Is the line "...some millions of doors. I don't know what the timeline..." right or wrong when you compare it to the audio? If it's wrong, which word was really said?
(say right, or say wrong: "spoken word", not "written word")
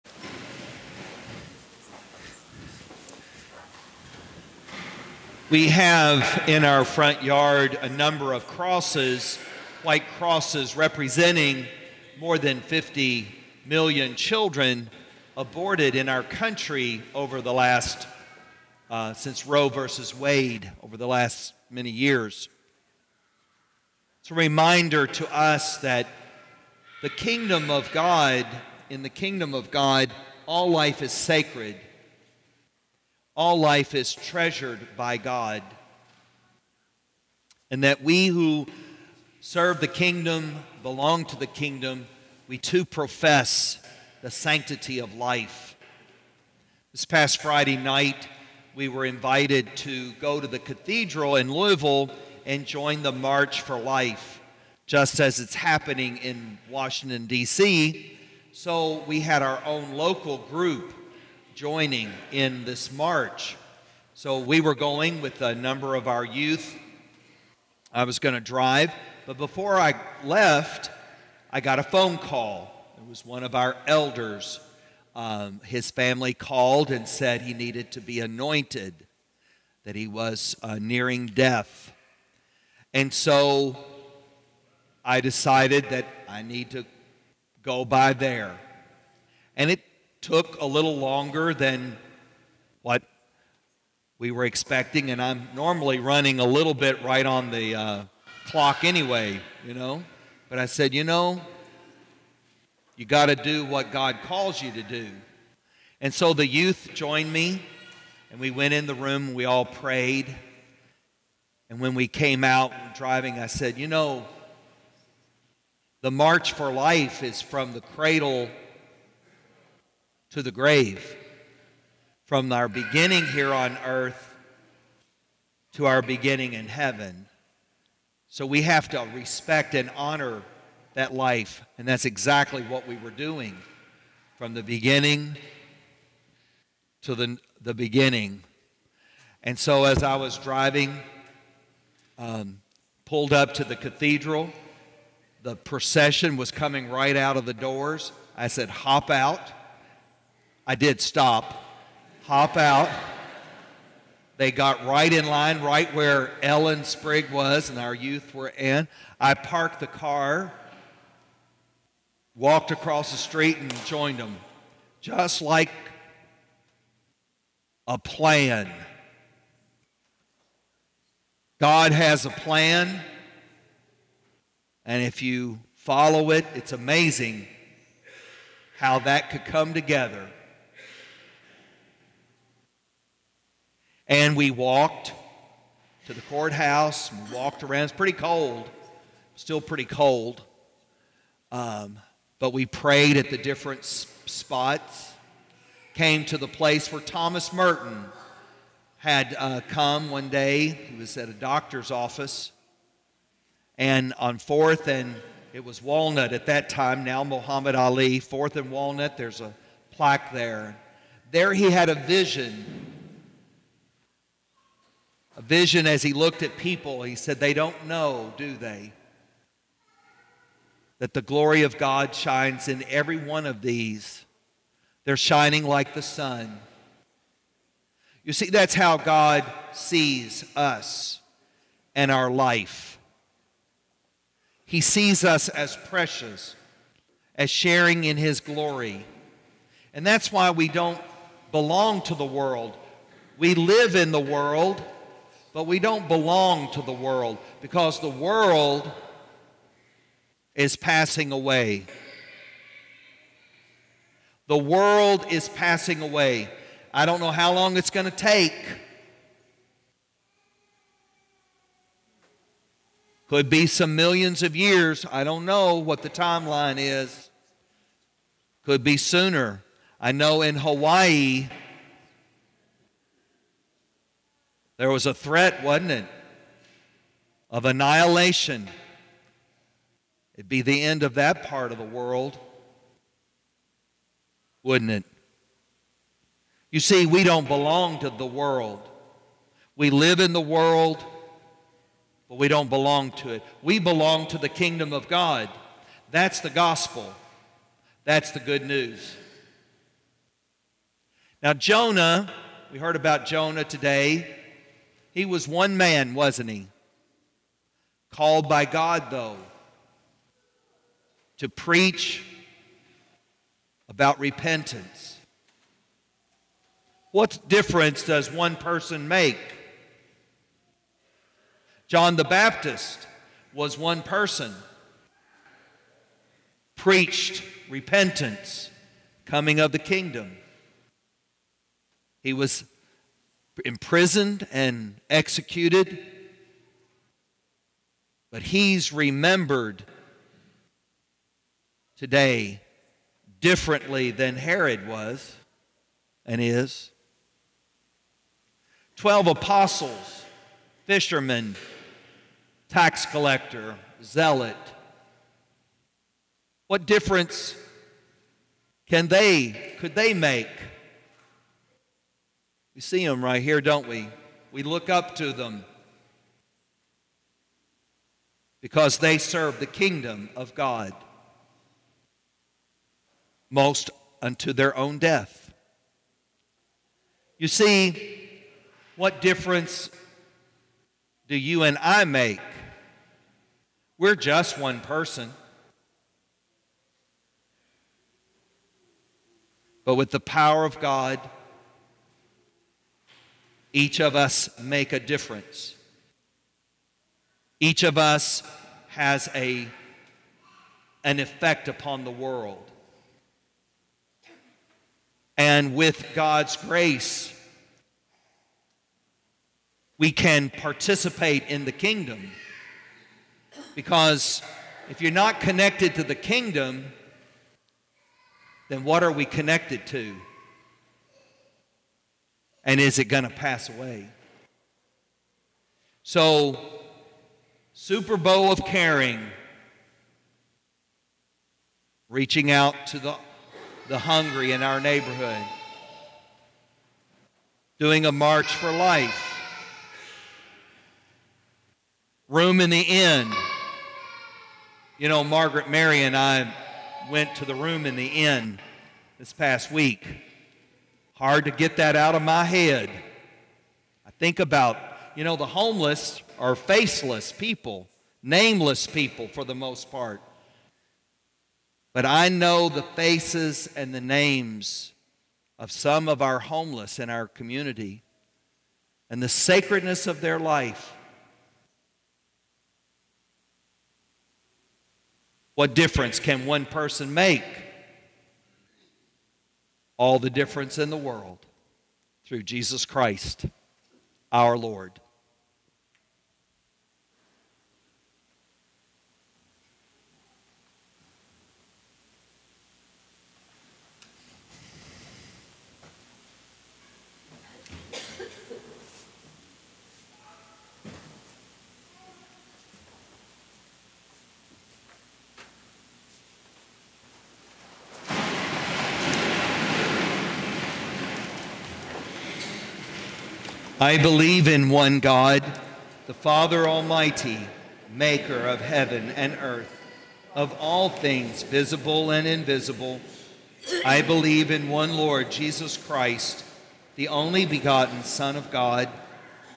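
wrong: "years", not "doors".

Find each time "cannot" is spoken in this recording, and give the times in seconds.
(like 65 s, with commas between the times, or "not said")
not said.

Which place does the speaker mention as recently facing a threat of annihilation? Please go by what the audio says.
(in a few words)
Hawaii.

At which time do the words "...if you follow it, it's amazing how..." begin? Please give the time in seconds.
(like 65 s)
175 s.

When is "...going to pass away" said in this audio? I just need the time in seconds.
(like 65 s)
423 s.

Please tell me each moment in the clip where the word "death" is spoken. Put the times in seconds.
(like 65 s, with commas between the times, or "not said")
81 s, 374 s.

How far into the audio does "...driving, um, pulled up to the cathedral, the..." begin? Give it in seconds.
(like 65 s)
140 s.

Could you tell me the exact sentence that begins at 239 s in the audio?
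And that's why we don't belong to the world.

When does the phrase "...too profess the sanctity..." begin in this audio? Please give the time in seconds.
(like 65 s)
42 s.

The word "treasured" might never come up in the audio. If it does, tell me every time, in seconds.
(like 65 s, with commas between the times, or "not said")
34 s.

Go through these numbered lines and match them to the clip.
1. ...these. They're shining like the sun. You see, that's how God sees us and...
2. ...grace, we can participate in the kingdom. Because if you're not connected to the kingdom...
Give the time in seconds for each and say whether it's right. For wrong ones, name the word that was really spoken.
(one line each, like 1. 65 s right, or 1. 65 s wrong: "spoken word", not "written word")
1. 223 s right
2. 406 s right.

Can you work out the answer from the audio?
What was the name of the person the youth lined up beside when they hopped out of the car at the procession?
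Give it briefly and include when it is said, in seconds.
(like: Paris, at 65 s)
Ellen Sprigg, at 156 s.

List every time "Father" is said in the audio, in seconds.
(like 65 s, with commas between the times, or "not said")
516 s.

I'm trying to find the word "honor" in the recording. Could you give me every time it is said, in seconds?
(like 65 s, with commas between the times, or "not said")
129 s.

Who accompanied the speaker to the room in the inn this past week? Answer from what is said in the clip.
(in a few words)
Margaret Mary.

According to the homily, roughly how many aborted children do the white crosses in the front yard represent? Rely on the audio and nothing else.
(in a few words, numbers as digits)
more than 50 million.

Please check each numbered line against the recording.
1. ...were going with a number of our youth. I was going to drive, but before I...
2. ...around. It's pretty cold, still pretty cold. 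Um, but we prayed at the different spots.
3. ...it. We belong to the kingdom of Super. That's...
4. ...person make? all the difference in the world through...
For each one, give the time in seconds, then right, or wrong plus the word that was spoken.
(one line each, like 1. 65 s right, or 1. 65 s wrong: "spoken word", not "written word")
1. 64 s right
2. 187 s right
3. 293 s wrong: "God", not "Super"
4. 476 s right.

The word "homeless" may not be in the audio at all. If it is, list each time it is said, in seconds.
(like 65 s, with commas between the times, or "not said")
455 s, 466 s.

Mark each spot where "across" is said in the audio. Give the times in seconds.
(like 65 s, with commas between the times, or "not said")
162 s.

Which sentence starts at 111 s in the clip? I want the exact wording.
And when we came out driving, I said, you know, the March for Life is from the cradle to the grave.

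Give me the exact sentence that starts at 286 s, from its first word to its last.
You see, we don't belong to the world.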